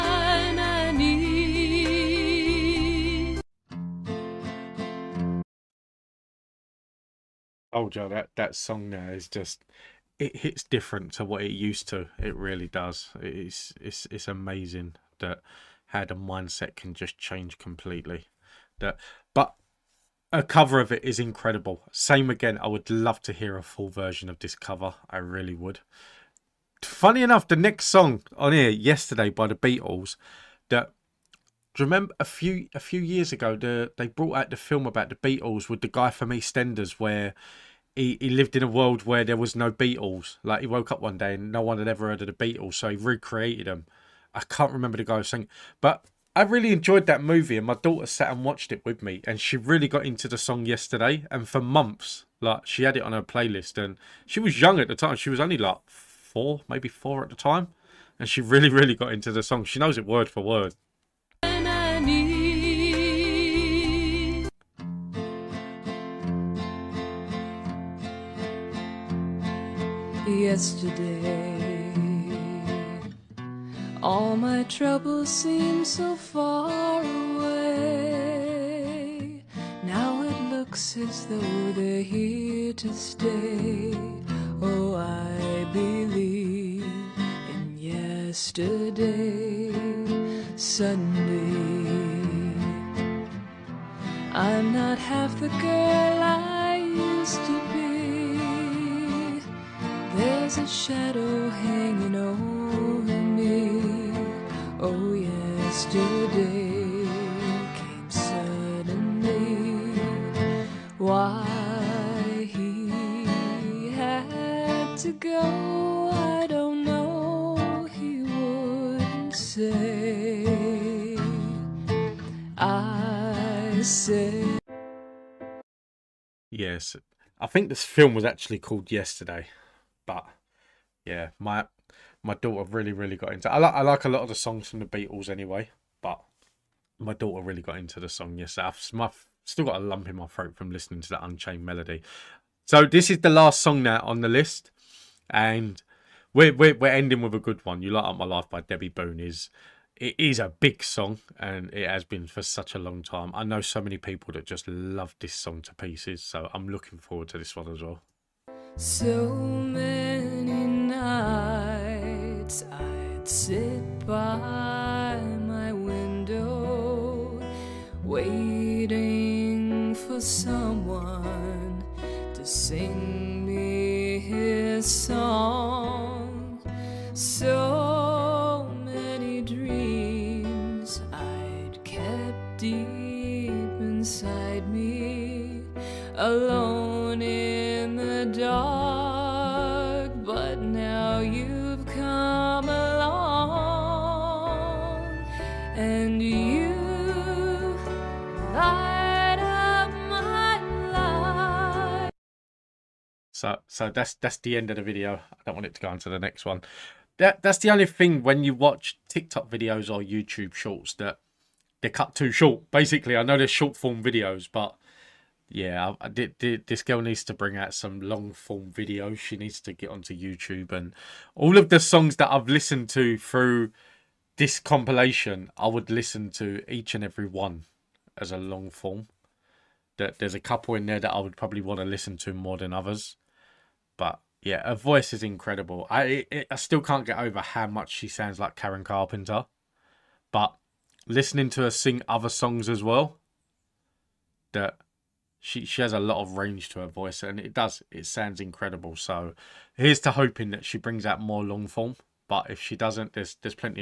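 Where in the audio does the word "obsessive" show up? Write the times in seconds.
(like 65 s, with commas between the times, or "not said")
not said.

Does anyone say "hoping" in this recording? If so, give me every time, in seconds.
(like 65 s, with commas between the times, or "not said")
250 s.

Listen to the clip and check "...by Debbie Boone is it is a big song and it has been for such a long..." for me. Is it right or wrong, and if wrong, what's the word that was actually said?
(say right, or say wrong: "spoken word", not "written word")
right.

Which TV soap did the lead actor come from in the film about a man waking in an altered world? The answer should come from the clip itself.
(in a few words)
EastEnders.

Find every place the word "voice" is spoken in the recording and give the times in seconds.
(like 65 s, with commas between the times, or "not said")
234 s, 246 s.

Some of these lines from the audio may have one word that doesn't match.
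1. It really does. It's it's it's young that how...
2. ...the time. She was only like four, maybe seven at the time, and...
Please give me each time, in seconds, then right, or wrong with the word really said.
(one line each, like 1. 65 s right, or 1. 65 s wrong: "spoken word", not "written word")
1. 12 s wrong: "amazing", not "young"
2. 54 s wrong: "four", not "seven".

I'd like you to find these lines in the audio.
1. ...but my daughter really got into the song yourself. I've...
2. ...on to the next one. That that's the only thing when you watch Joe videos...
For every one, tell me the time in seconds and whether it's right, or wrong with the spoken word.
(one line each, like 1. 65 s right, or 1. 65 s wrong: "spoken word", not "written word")
1. 136 s right
2. 205 s wrong: "TikTok", not "Joe".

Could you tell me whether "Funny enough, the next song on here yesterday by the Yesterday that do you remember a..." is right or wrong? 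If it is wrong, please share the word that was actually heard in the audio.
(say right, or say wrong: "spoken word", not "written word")
wrong: "Beatles", not "Yesterday".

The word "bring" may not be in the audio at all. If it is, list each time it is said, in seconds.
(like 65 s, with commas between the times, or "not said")
217 s, 250 s.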